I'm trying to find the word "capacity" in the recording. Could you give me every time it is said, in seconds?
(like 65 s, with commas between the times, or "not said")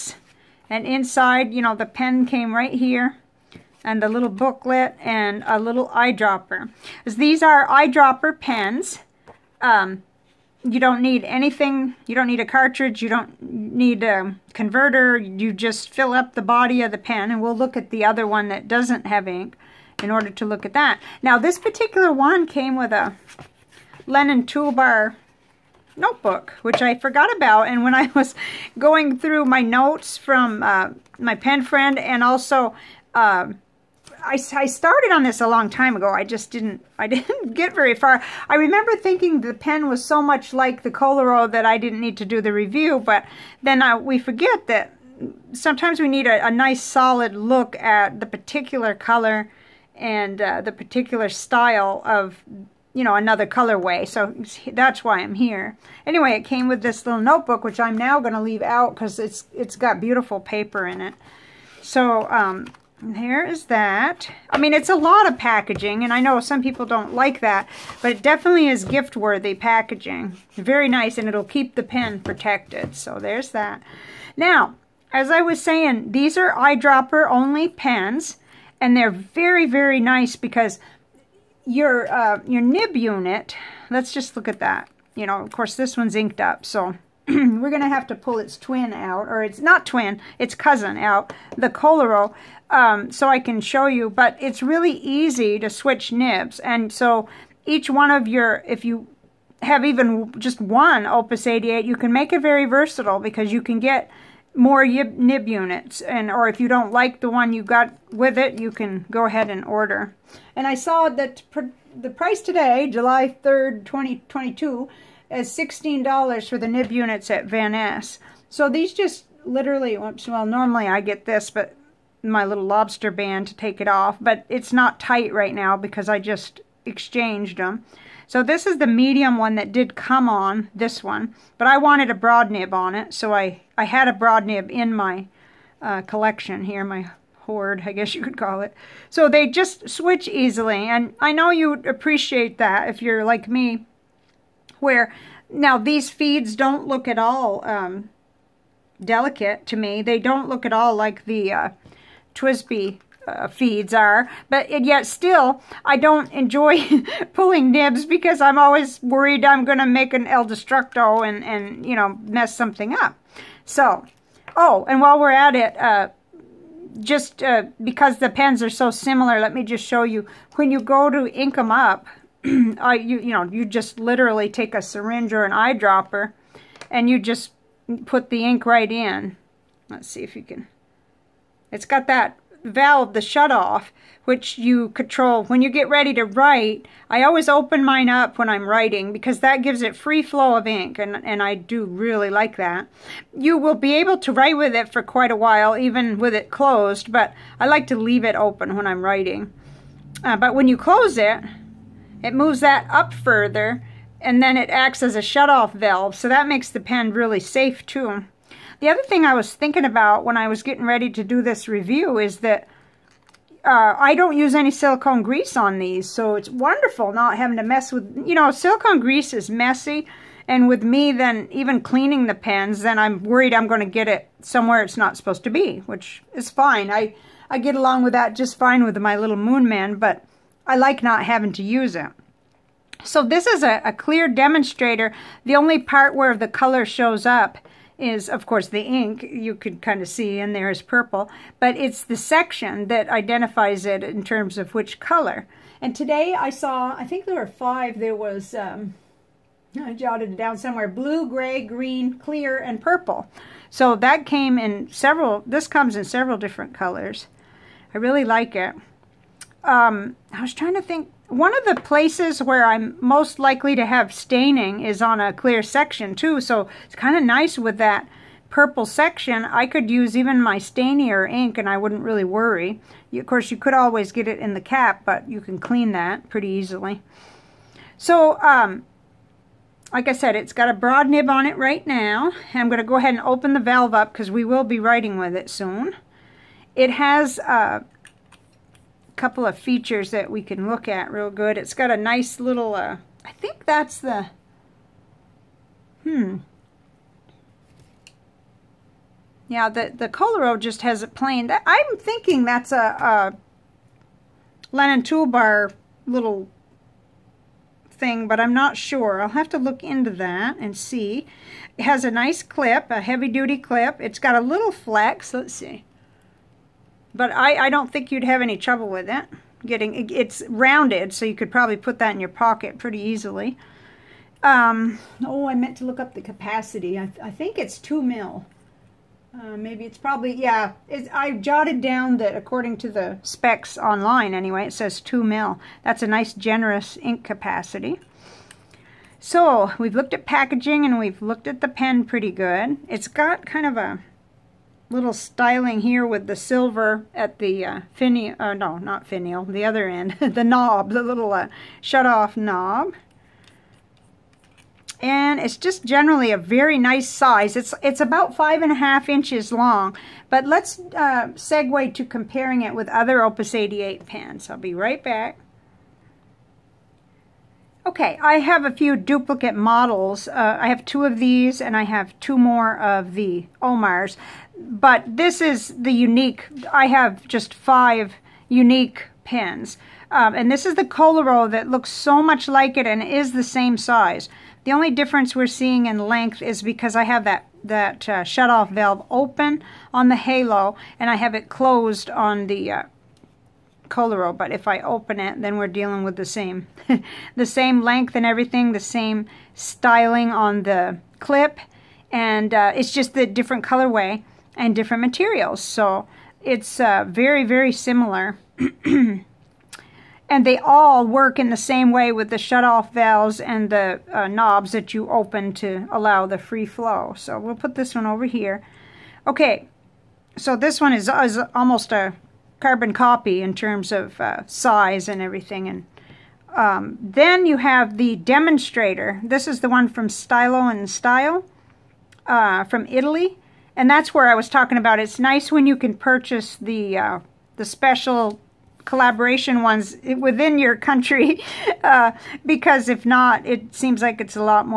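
326 s, 337 s.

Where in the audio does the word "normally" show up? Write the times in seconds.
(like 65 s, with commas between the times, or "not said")
120 s.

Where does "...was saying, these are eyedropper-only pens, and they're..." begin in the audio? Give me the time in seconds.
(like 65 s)
75 s.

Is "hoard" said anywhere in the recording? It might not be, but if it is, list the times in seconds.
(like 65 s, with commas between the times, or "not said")
137 s.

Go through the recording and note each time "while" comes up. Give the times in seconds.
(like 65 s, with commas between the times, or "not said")
165 s, 195 s.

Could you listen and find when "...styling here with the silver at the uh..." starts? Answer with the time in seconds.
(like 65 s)
345 s.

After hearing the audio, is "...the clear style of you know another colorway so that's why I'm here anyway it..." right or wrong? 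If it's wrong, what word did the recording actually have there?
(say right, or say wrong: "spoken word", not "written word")
wrong: "particular", not "clear".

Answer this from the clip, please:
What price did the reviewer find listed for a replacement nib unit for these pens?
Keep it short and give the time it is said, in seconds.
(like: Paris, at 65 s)
$16, at 115 s.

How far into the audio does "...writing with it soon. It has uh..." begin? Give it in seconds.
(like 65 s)
284 s.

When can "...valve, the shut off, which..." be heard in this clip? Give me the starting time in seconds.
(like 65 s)
182 s.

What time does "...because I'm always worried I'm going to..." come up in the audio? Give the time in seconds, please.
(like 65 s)
158 s.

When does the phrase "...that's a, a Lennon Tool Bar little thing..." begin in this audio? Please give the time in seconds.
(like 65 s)
302 s.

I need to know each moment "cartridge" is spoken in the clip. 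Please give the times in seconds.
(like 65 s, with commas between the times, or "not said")
12 s.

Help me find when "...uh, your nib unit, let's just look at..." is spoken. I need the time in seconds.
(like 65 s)
82 s.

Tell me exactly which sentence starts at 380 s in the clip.
Um, and this is the Koloro that looks so much like it and is the same size.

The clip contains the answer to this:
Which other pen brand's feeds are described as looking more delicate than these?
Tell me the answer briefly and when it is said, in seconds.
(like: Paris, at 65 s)
TWSBI, at 152 s.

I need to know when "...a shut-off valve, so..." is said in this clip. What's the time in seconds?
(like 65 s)
205 s.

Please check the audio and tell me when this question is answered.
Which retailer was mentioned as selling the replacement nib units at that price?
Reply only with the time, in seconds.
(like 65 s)
117 s.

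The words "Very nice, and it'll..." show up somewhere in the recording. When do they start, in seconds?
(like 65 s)
70 s.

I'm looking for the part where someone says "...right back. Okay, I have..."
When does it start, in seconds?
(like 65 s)
364 s.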